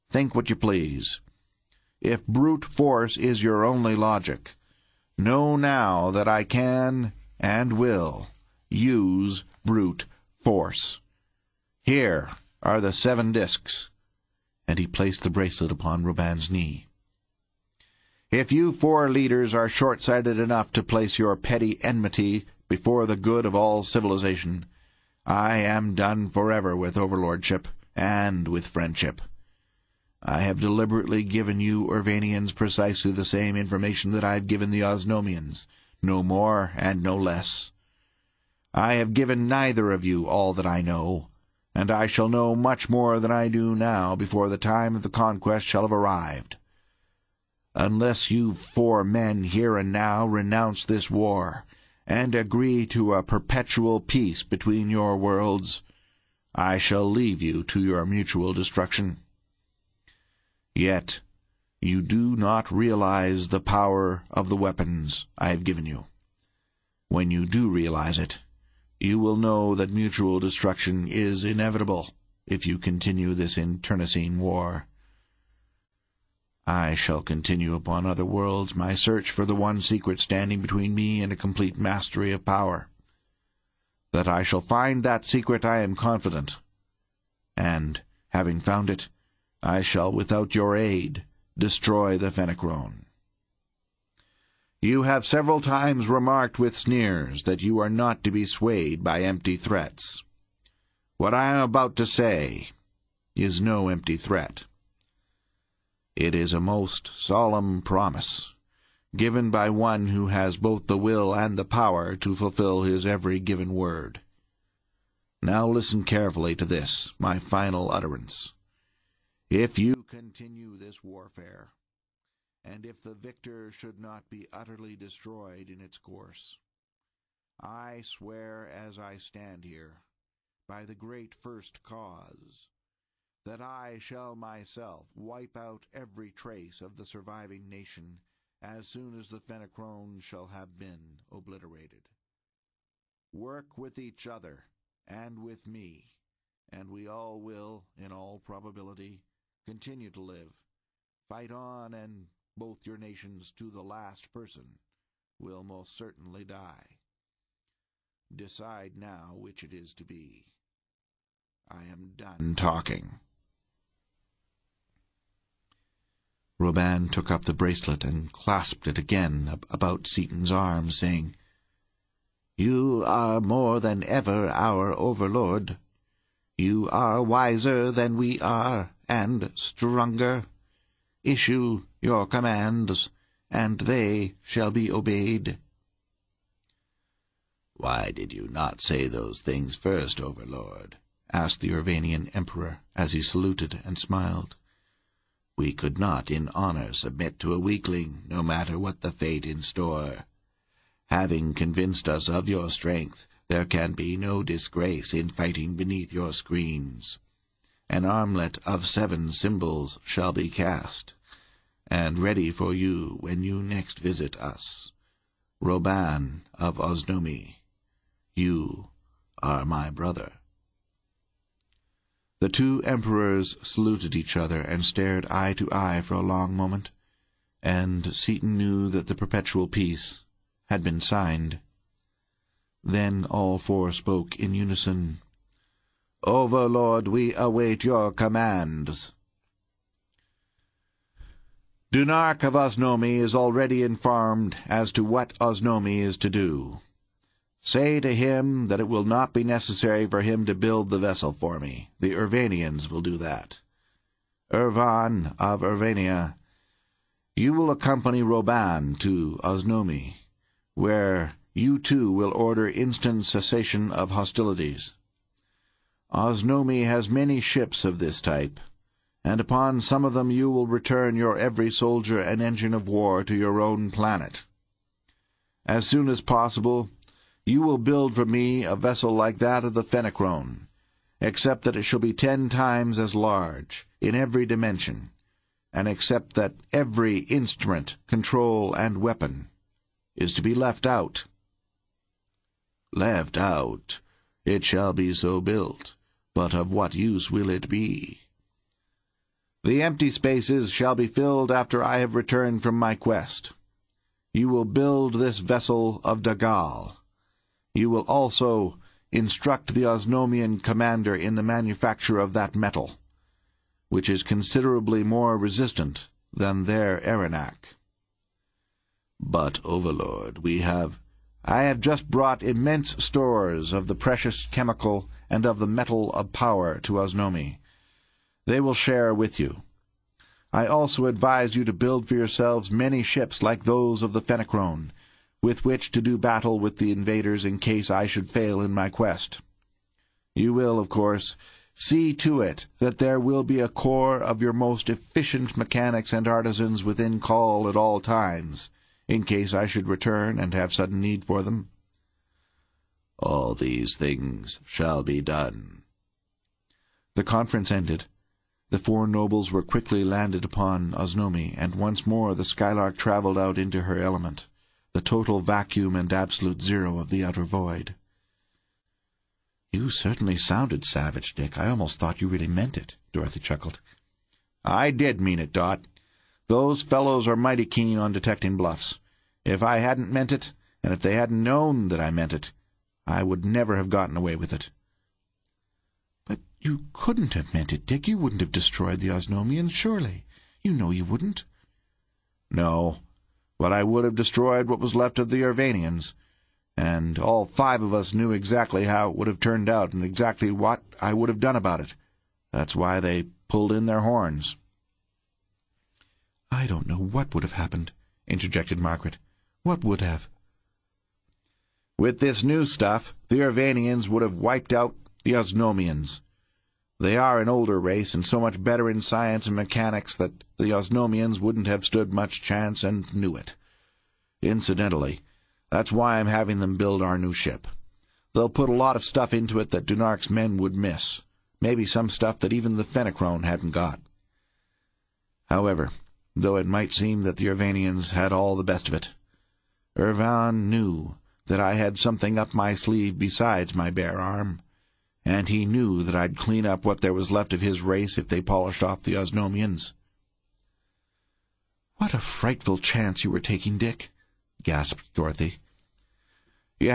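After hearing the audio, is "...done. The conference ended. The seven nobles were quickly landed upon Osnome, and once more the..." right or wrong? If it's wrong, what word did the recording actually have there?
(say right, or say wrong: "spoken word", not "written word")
wrong: "four", not "seven".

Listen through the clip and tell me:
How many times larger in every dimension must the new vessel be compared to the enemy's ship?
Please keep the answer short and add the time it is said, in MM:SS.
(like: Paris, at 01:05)
10, at 04:42.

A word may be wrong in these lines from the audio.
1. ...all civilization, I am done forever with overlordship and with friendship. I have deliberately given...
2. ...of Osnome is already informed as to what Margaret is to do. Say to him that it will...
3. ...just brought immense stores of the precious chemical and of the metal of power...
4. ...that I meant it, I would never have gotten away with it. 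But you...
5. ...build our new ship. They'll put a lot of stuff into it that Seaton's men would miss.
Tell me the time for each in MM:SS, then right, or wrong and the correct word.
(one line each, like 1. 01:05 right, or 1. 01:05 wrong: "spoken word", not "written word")
1. 00:23 right
2. 04:02 wrong: "Osnome", not "Margaret"
3. 05:21 right
4. 06:21 right
5. 07:06 wrong: "Dunark", not "Seaton".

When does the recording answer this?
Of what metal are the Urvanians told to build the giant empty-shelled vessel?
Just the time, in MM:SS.
05:06.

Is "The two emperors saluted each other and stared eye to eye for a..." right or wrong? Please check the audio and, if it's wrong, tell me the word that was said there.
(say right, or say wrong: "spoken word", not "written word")
right.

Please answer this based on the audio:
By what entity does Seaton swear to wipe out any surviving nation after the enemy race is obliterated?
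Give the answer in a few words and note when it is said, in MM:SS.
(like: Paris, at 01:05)
the great First Cause, at 02:10.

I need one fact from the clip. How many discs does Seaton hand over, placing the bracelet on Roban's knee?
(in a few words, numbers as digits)
7.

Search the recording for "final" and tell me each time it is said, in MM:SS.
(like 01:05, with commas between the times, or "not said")
01:57.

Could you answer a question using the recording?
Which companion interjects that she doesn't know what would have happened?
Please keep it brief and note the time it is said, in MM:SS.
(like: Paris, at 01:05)
Margaret, at 06:48.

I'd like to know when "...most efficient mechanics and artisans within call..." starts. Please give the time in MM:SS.
05:44.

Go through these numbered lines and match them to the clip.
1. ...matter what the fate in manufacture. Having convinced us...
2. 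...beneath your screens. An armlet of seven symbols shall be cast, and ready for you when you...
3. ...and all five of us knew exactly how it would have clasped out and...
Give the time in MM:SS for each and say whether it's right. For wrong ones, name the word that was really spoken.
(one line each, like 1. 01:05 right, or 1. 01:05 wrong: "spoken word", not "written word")
1. 03:18 wrong: "store", not "manufacture"
2. 03:25 right
3. 06:36 wrong: "turned", not "clasped".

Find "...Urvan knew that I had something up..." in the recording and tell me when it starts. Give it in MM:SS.
07:19.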